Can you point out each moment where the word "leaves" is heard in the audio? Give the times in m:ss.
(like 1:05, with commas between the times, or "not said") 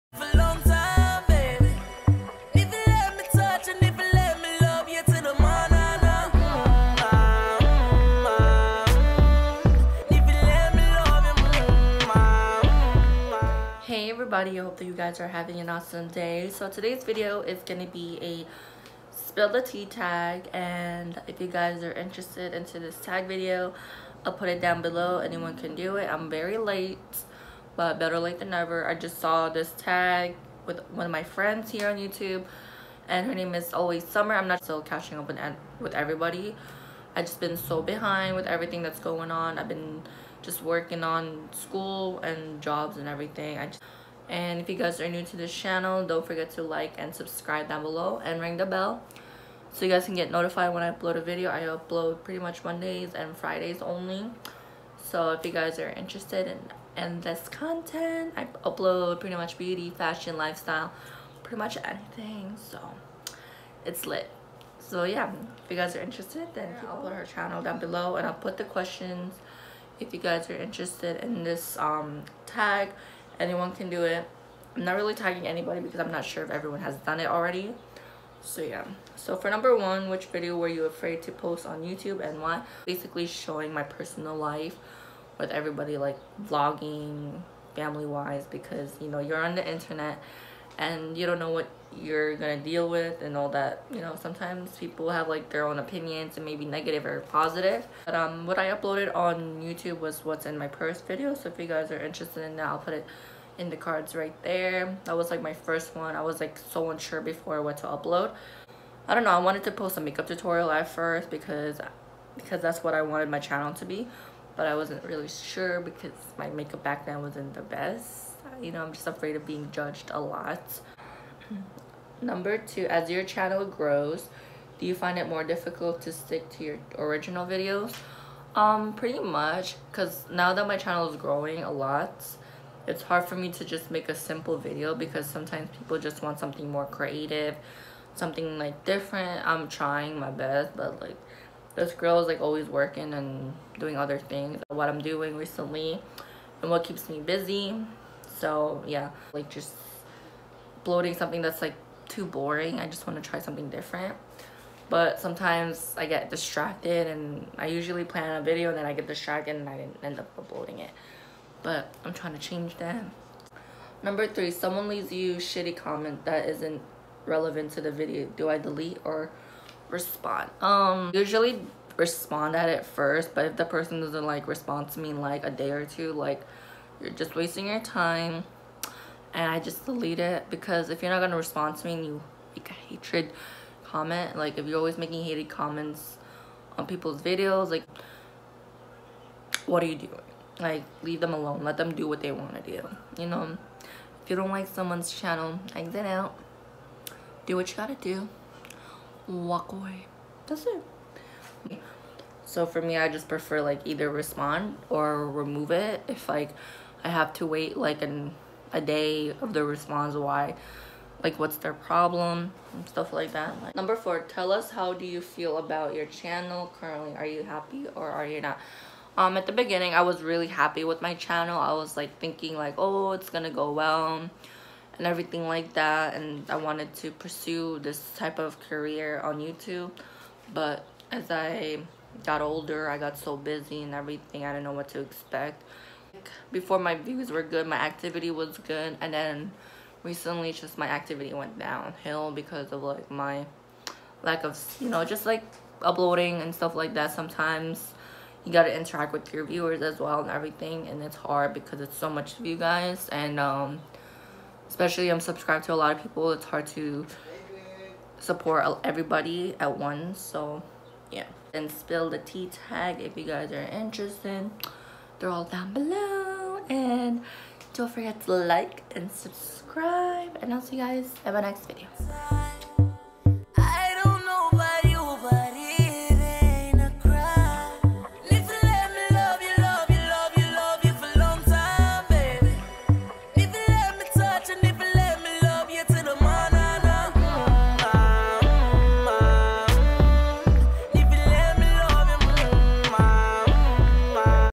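2:44, 3:11.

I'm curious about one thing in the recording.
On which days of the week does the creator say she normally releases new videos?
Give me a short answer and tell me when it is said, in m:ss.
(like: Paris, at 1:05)
Mondays and Fridays, at 0:52.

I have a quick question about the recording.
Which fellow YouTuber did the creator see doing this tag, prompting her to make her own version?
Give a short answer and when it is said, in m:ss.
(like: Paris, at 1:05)
Always Summer, at 0:33.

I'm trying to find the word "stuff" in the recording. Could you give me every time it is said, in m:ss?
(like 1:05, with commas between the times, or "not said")
3:32, 4:06.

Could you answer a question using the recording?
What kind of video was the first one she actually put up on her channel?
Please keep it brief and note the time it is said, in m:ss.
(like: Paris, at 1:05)
What's in my purse, at 1:40.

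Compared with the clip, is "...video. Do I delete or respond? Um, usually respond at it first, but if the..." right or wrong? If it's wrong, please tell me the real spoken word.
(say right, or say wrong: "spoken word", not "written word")
right.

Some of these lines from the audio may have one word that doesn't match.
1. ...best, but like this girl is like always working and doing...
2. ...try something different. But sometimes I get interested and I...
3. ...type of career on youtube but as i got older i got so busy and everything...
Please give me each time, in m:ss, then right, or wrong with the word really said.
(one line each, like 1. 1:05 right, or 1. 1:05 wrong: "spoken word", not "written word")
1. 2:20 right
2. 2:33 wrong: "distracted", not "interested"
3. 3:48 right.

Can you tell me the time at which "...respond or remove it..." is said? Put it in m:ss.
3:24.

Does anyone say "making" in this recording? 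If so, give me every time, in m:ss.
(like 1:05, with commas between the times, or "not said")
3:04.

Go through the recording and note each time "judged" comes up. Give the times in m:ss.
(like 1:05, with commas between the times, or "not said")
1:59.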